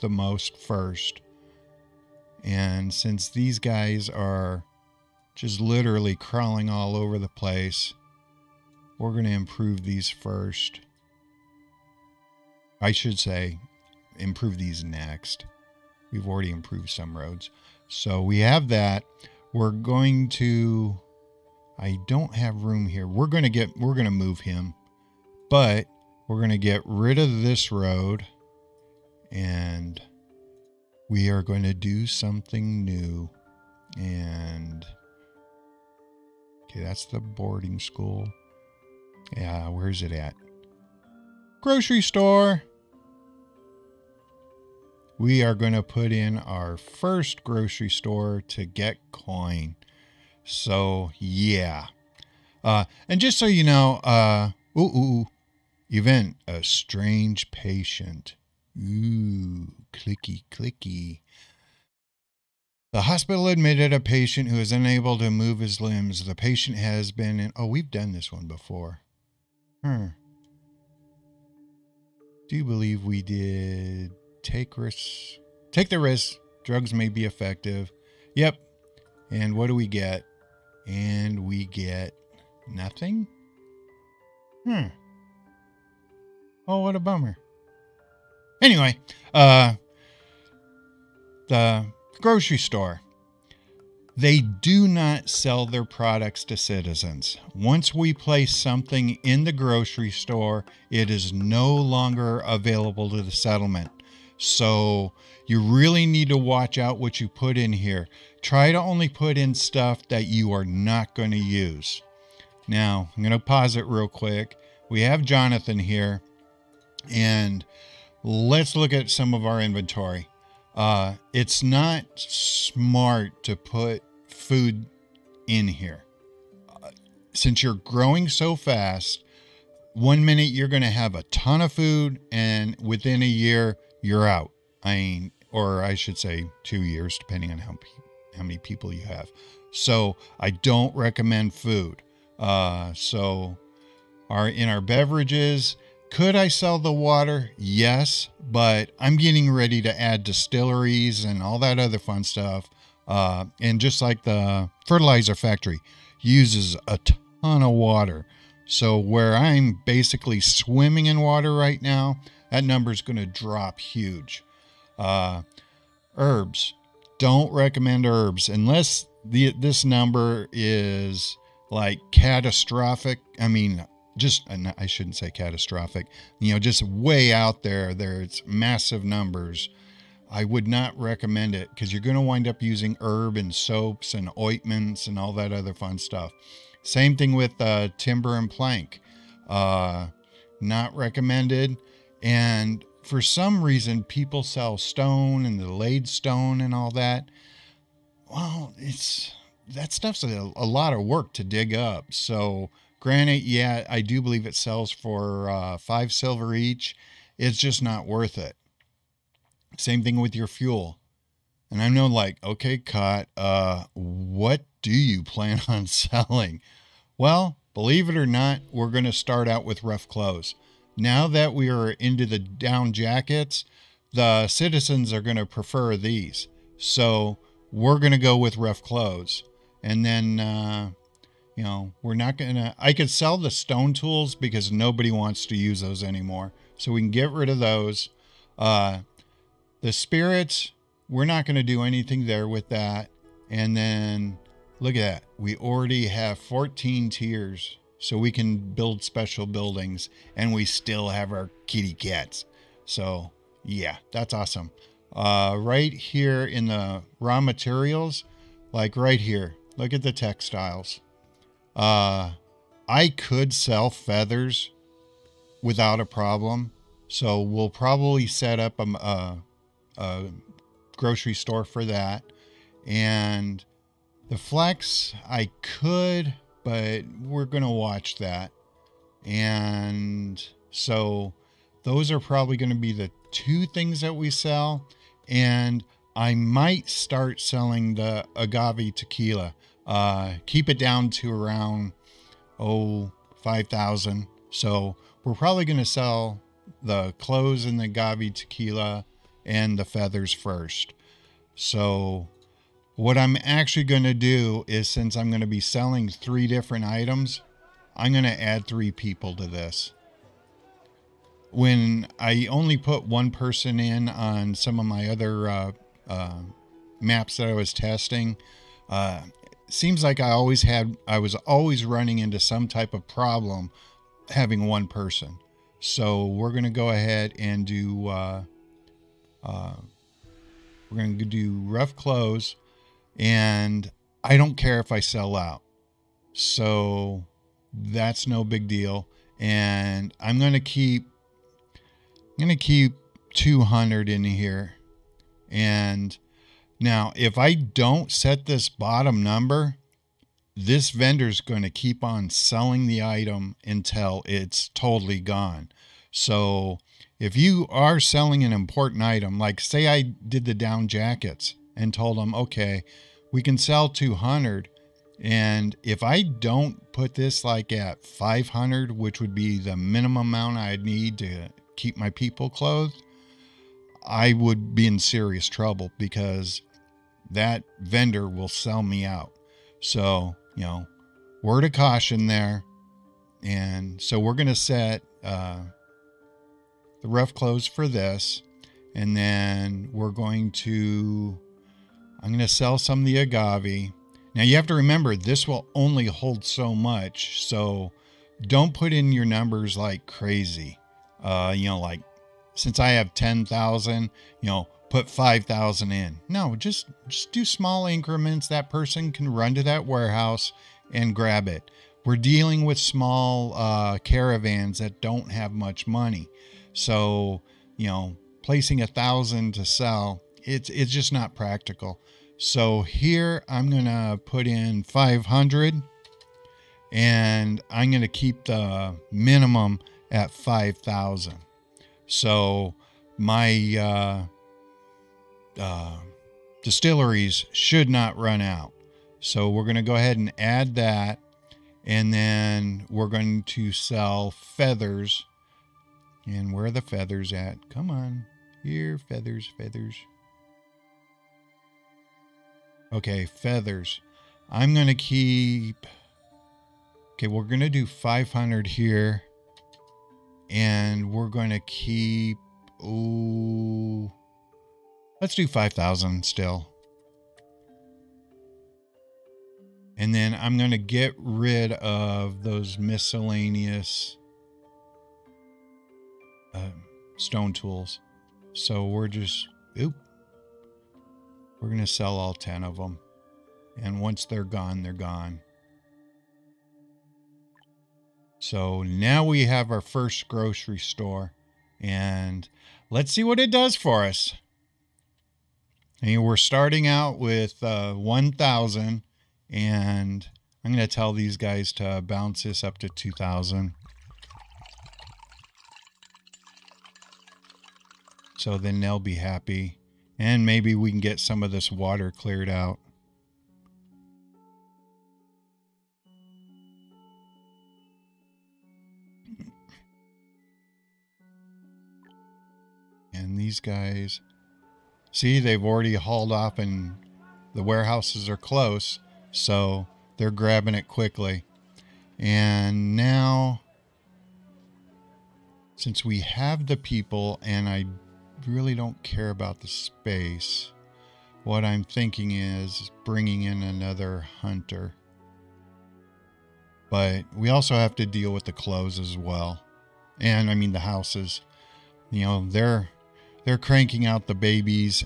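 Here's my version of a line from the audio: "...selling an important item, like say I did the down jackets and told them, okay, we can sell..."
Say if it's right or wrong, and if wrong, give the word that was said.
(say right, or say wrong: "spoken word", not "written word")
right.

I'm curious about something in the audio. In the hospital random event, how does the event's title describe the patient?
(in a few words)
A strange patient.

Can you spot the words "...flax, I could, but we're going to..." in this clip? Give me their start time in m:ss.
4:34.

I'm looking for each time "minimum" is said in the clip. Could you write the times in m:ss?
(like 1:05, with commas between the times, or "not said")
6:09, 7:09.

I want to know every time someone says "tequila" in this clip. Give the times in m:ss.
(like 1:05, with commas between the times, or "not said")
4:48, 4:58.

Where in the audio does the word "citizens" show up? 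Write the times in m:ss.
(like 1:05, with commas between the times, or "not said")
1:36, 3:44.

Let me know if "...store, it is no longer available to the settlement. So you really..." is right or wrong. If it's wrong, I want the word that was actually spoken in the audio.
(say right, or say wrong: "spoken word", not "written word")
right.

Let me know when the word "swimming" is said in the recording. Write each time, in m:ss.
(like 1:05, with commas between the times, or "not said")
2:40.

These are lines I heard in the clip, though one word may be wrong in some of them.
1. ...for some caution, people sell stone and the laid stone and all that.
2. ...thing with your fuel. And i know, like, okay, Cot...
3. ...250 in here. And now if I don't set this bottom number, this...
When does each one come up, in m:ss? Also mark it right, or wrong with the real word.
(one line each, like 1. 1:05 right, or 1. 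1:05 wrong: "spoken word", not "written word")
1. 3:13 wrong: "reason", not "caution"
2. 3:30 right
3. 5:43 wrong: "200", not "250".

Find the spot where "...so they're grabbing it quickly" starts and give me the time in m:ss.
8:49.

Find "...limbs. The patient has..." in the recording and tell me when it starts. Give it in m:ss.
1:05.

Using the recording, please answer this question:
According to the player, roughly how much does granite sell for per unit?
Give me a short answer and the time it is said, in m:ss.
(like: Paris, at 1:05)
5 silver, at 3:25.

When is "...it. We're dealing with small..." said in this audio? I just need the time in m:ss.
6:51.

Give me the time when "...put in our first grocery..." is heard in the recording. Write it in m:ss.
0:45.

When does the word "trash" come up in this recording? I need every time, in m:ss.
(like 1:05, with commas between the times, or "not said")
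not said.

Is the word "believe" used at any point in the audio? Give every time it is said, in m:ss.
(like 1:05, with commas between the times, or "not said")
1:12, 3:24, 3:37.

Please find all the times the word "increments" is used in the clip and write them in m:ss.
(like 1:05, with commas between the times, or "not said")
6:47.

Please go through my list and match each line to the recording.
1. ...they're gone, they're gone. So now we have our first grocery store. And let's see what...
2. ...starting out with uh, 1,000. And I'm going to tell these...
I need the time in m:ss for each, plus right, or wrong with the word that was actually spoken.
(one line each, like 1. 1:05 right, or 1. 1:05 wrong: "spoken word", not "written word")
1. 8:04 right
2. 8:16 right.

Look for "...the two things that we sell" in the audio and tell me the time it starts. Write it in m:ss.
4:42.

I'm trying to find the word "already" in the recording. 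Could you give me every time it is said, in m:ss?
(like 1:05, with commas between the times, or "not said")
0:16, 4:05, 8:45.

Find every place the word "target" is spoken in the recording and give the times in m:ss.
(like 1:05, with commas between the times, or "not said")
not said.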